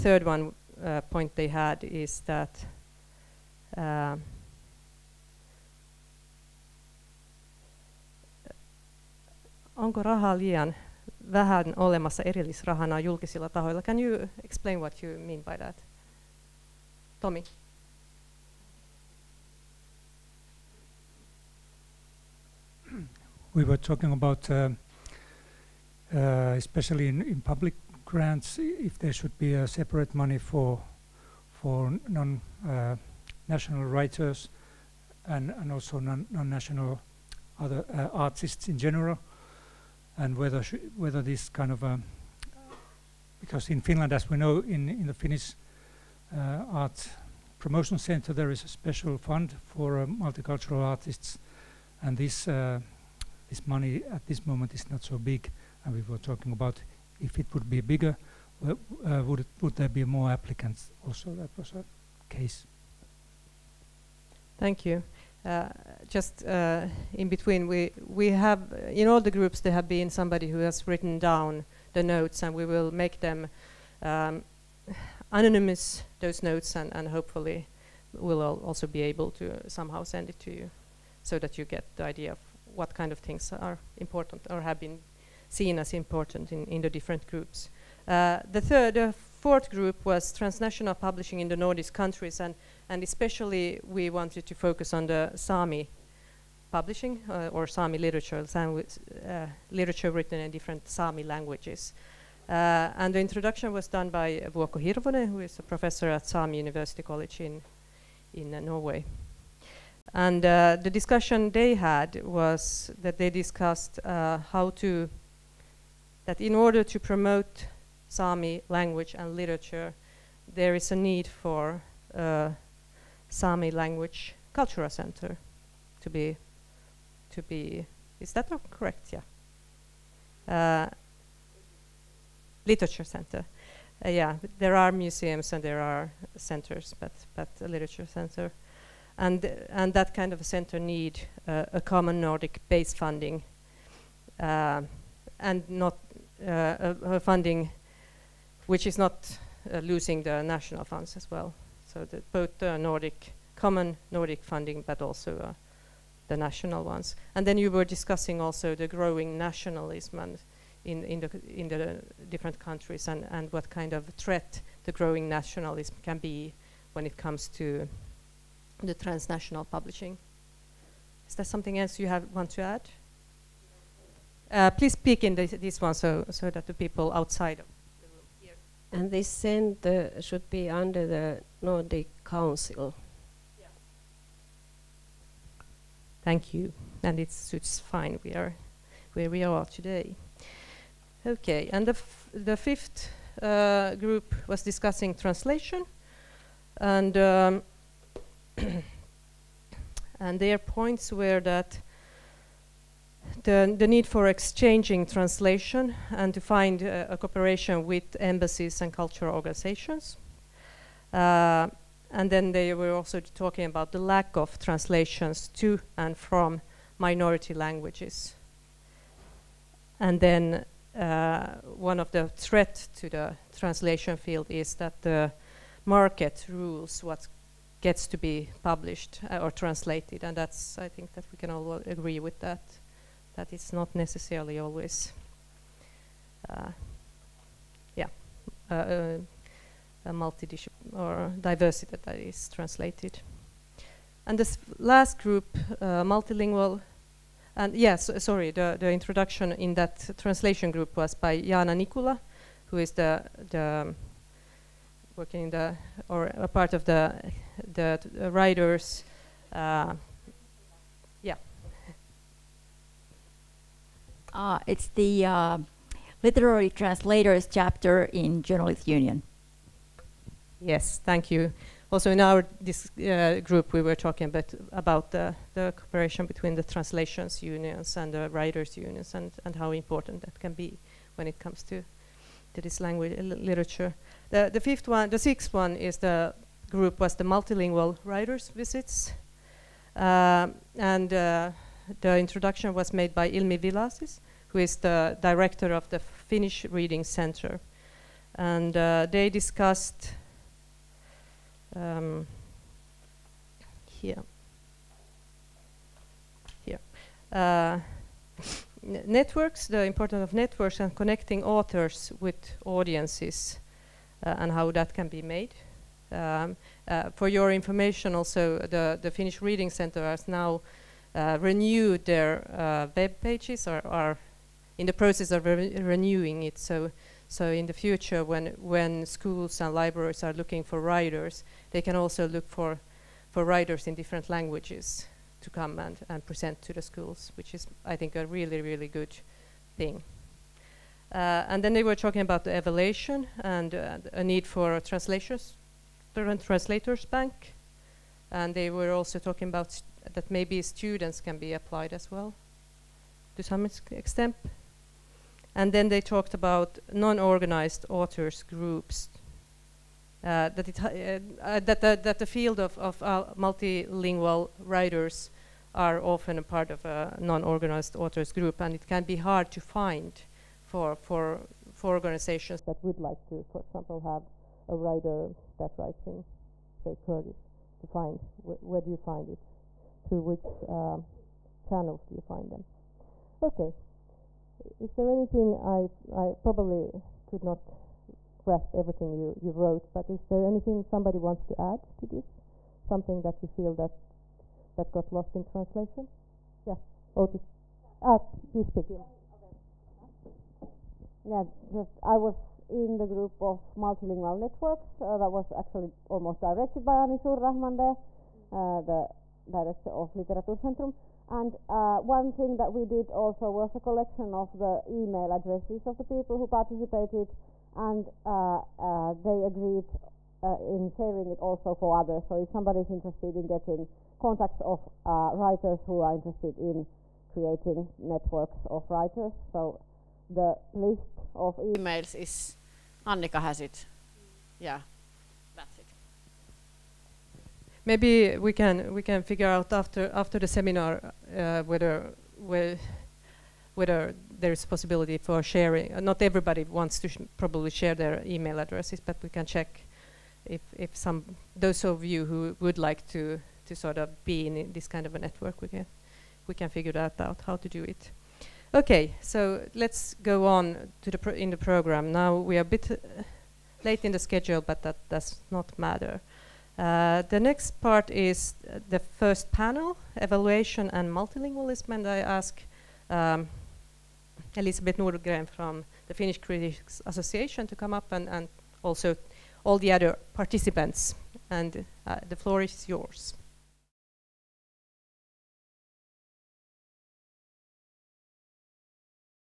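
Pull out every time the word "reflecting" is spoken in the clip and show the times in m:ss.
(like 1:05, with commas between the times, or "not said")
not said.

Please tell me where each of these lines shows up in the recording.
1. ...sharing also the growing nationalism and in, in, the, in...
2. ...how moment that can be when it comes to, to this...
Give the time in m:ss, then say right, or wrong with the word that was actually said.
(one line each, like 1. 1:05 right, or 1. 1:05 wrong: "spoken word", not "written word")
1. 2:37 wrong: "discussing", not "sharing"
2. 4:39 wrong: "important", not "moment".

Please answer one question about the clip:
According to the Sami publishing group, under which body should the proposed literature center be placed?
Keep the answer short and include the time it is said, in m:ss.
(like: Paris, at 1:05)
Nordic Council, at 3:01.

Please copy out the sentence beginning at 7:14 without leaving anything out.
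Yeah maybe we can we can figure out after after the seminar uh, whether whe whether there is possibility for sharing.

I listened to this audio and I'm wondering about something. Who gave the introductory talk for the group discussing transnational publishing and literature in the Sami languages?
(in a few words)
Vuokko Hirvonen.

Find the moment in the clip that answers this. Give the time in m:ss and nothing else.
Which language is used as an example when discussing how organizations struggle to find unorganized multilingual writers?
6:16.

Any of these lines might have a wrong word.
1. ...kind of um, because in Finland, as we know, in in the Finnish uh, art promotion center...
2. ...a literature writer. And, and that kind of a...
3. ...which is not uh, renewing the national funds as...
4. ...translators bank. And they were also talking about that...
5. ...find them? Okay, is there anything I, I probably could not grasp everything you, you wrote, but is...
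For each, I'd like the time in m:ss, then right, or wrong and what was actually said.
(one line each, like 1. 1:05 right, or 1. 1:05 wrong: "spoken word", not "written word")
1. 0:41 right
2. 2:17 wrong: "center", not "writer"
3. 2:28 wrong: "losing", not "renewing"
4. 5:46 right
5. 6:22 right.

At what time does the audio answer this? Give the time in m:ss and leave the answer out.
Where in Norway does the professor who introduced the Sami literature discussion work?
1:46.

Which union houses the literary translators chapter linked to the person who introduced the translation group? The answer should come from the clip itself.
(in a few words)
Journalist Union.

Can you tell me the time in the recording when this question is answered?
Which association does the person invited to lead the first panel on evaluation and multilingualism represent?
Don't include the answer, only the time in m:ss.
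7:56.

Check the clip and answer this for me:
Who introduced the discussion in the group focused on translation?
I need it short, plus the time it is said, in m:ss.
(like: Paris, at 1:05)
Jana Nikula, at 4:11.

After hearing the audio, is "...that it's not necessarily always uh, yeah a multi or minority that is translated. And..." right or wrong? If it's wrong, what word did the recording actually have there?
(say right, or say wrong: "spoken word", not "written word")
wrong: "diversity", not "minority".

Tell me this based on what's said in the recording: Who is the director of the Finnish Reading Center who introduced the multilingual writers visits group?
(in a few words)
Ilmi Villacís.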